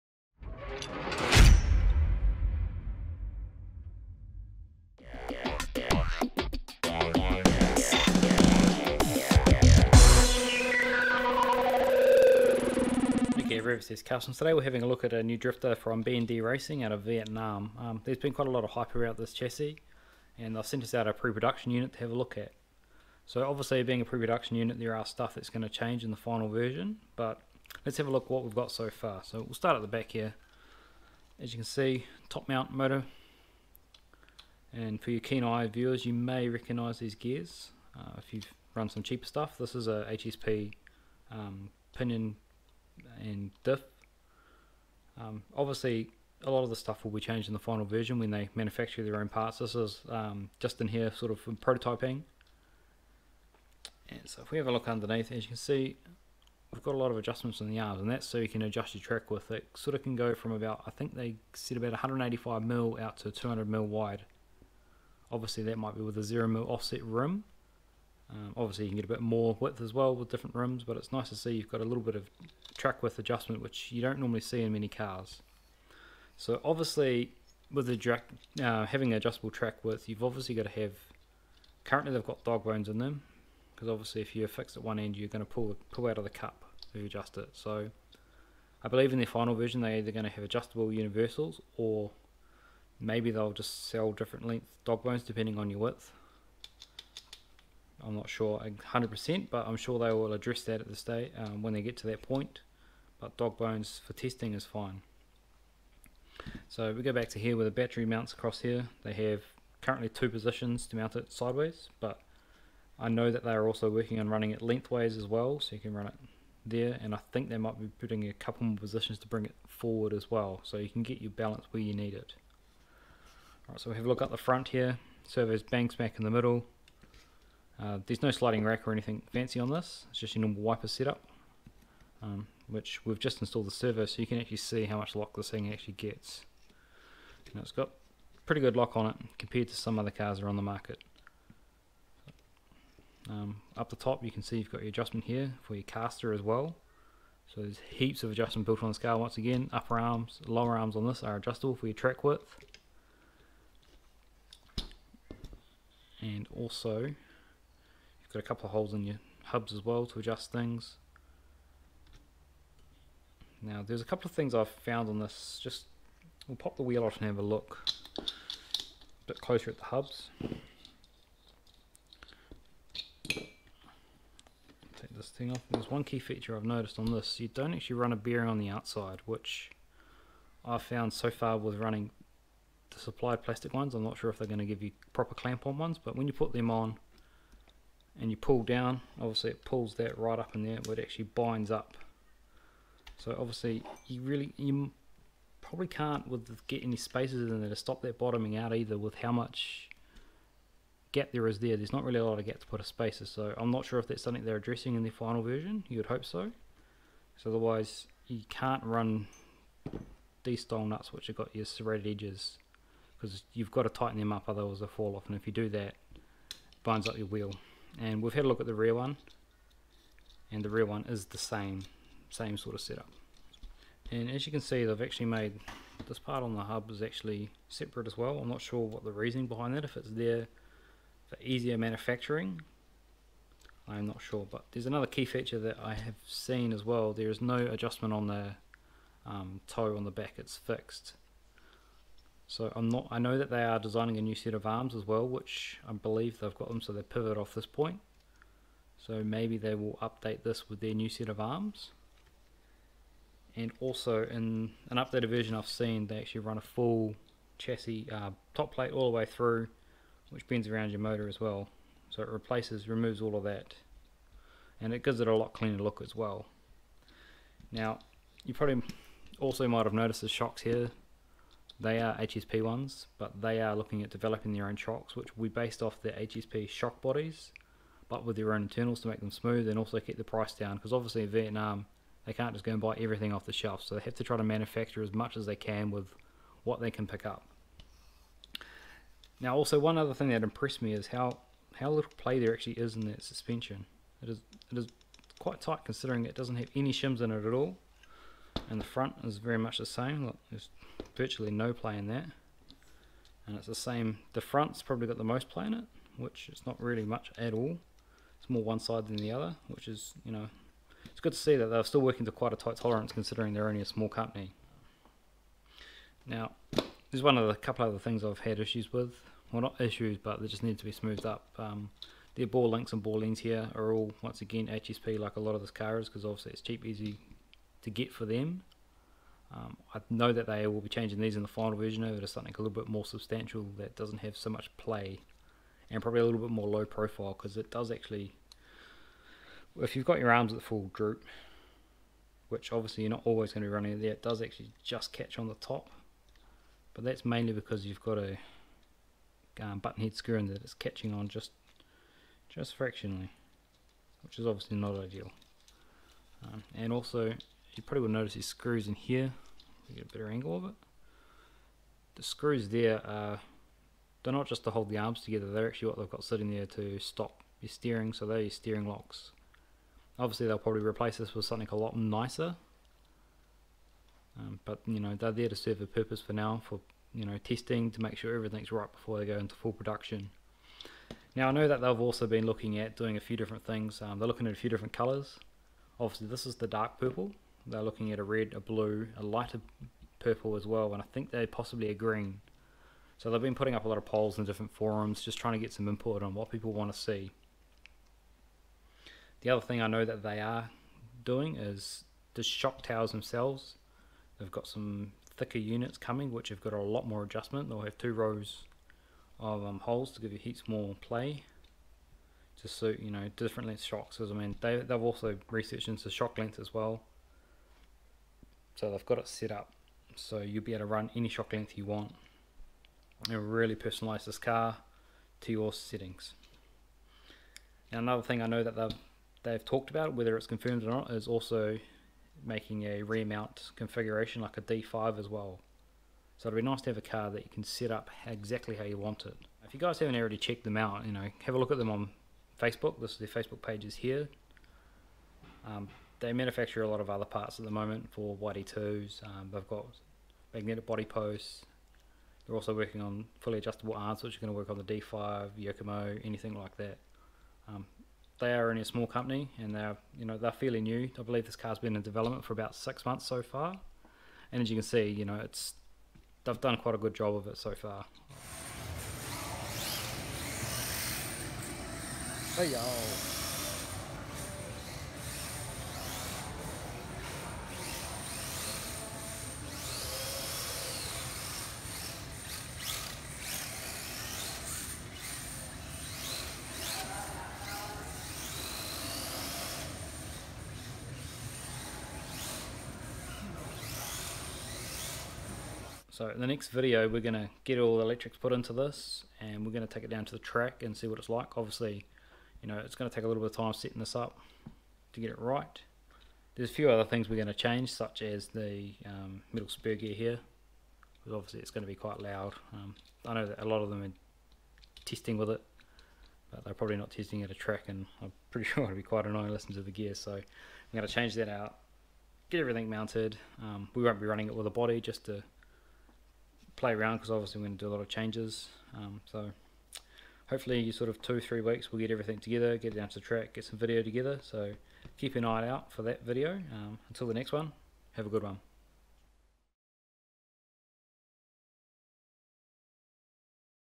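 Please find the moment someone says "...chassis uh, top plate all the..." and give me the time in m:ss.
4:17.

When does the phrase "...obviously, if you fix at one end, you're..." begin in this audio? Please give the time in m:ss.
1:23.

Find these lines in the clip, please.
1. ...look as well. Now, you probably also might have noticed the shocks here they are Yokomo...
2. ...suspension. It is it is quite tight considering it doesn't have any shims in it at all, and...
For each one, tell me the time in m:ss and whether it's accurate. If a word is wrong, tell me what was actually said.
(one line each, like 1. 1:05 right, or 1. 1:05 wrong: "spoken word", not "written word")
1. 4:25 wrong: "HSP", not "Yokomo"
2. 4:53 right.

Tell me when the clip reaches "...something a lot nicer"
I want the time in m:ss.
6:11.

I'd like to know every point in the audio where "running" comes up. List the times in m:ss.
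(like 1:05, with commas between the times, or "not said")
1:54, 3:01, 5:43, 8:44.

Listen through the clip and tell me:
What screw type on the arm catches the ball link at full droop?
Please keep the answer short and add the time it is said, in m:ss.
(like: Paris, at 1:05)
button head screw, at 5:49.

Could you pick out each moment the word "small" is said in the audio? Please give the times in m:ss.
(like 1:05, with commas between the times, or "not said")
5:13, 7:38.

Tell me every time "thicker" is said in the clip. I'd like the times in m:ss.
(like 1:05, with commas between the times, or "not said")
6:45.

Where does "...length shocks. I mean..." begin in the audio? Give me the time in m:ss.
6:53.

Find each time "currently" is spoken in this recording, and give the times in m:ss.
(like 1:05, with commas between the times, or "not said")
1:21, 1:49.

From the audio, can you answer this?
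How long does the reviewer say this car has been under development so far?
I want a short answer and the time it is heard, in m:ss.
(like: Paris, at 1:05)
six months, at 7:42.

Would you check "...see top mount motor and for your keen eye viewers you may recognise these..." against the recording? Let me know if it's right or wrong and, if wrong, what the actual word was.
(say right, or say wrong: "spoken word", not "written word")
right.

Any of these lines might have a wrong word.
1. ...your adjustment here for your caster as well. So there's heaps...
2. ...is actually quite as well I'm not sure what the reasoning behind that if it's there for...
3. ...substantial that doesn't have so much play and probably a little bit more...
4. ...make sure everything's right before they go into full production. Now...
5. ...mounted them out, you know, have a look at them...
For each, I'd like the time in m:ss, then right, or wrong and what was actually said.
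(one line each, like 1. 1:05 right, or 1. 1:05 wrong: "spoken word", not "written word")
1. 2:24 right
2. 3:46 wrong: "separate", not "quite"
3. 5:33 right
4. 6:18 right
5. 7:20 wrong: "checked", not "mounted".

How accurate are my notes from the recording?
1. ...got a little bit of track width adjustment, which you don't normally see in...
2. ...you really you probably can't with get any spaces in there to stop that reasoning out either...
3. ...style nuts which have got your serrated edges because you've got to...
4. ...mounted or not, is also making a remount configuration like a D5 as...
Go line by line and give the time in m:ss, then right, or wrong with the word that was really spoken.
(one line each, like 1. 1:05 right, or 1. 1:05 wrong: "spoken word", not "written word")
1. 1:11 right
2. 3:14 wrong: "bottoming", not "reasoning"
3. 3:30 right
4. 7:10 wrong: "confirmed", not "mounted".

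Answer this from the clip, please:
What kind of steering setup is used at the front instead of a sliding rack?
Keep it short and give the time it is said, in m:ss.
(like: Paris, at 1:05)
wiper setup, at 2:10.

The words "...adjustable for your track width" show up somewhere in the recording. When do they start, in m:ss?
2:31.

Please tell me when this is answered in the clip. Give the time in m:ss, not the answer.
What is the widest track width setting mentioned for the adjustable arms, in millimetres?
1:03.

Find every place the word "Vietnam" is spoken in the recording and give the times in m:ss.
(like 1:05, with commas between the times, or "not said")
0:17, 4:41.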